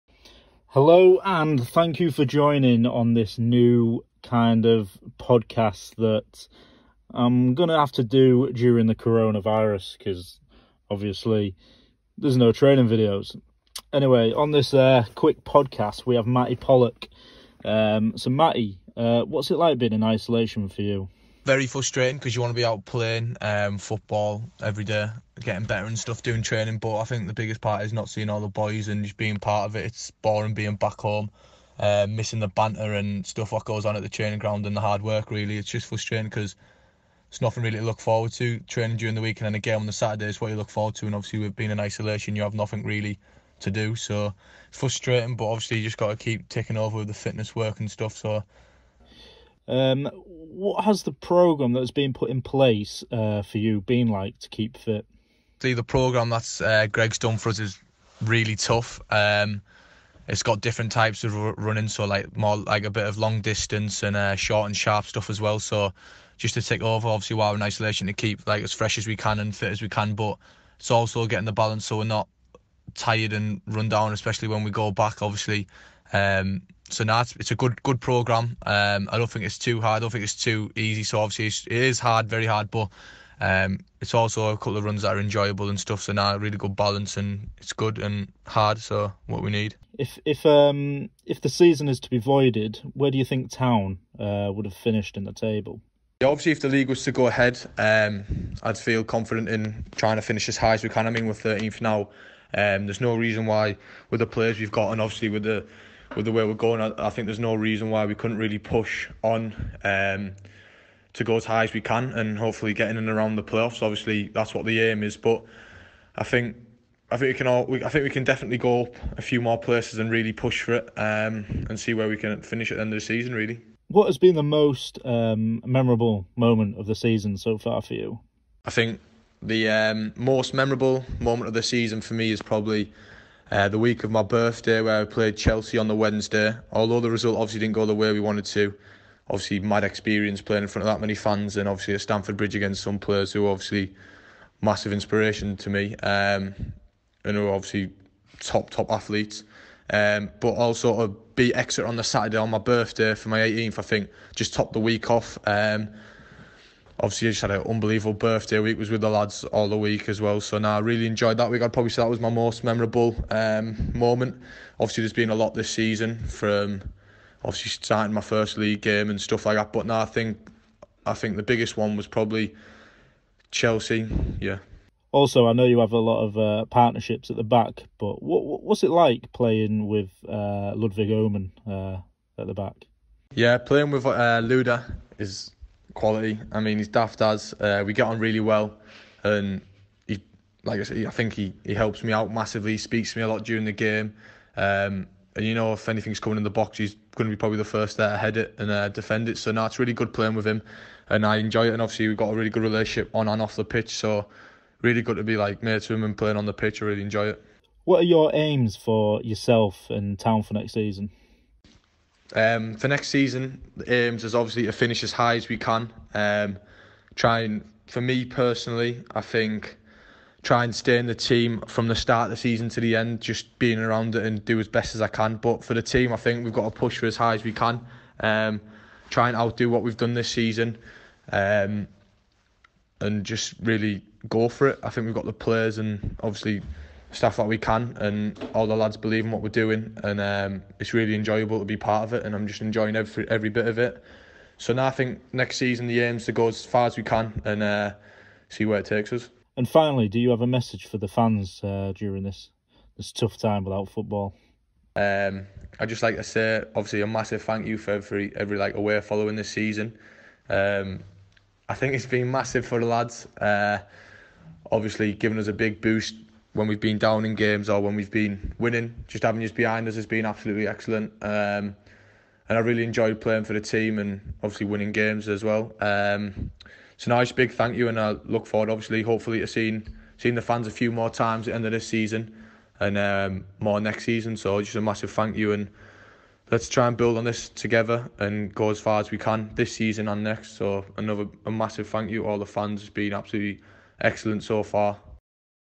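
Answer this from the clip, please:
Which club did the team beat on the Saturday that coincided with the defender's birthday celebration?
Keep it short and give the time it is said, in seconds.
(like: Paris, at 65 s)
Exeter, at 151 s.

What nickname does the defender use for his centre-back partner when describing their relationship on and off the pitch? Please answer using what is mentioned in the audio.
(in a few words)
Luda.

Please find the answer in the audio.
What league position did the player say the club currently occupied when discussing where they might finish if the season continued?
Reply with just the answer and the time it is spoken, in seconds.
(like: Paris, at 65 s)
13th, at 101 s.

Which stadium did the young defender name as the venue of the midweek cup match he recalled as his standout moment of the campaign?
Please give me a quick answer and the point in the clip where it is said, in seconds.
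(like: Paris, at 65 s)
Stamford Bridge, at 142 s.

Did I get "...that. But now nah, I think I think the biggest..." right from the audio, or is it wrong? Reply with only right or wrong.
right.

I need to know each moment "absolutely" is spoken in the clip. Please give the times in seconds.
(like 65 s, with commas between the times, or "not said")
270 s, 293 s.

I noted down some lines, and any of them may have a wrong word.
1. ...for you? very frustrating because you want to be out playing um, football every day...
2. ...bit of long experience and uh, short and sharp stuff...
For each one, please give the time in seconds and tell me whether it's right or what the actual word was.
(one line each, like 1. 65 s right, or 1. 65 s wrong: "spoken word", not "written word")
1. 20 s right
2. 62 s wrong: "distance", not "experience".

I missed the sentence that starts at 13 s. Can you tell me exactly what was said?
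Anyway, on this uh, quick podcast, we have Mattie Pollock.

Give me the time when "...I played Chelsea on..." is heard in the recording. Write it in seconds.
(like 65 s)
135 s.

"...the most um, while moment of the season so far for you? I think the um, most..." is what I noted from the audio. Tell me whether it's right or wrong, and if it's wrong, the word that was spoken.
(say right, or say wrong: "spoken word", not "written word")
wrong: "memorable", not "while".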